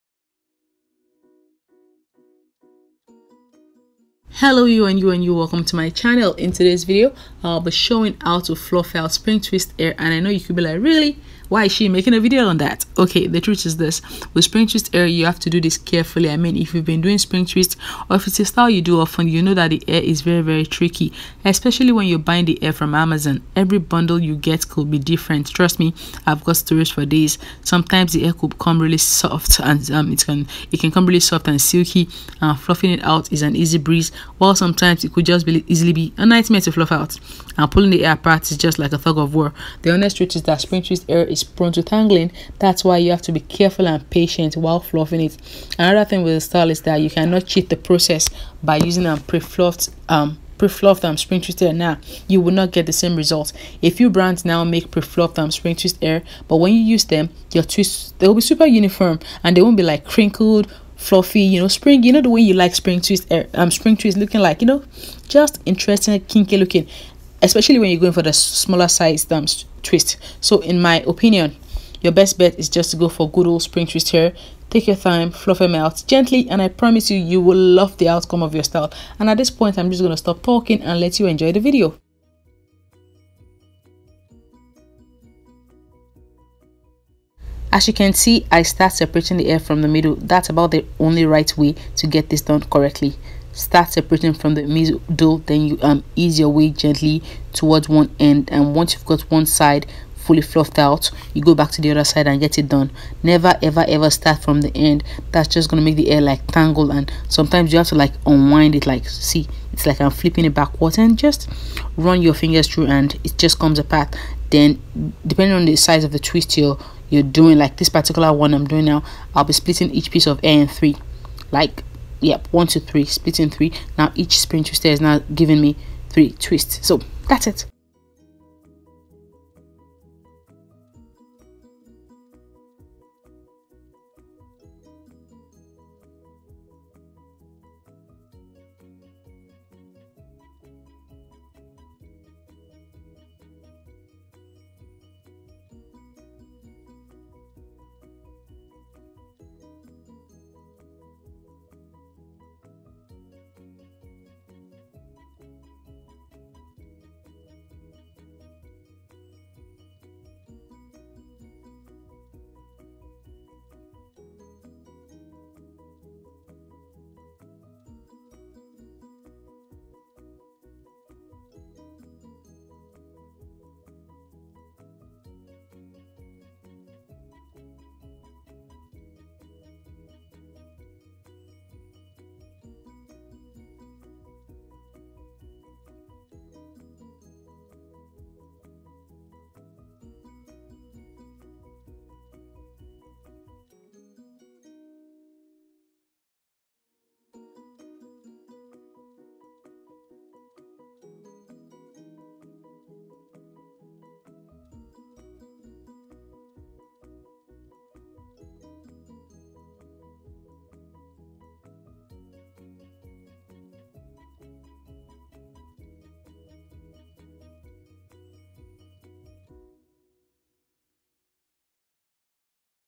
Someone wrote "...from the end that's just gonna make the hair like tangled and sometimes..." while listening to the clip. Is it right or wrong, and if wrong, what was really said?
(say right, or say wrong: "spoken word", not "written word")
right.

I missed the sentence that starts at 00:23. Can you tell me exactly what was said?
Every bundle you get could be different.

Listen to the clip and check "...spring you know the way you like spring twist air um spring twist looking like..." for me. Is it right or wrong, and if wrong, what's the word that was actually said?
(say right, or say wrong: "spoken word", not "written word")
right.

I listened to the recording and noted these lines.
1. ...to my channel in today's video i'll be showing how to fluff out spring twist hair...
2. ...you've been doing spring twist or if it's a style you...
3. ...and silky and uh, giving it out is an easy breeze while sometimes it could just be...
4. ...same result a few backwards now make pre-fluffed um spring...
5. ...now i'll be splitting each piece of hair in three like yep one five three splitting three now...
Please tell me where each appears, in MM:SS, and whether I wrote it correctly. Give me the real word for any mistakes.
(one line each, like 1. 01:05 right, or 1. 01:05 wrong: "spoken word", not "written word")
1. 00:05 right
2. 00:16 right
3. 00:31 wrong: "fluffing", not "giving"
4. 00:52 wrong: "brands", not "backwards"
5. 01:58 wrong: "two", not "five".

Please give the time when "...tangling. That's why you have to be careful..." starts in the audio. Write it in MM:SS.
00:41.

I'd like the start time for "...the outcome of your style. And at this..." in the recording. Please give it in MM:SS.
01:17.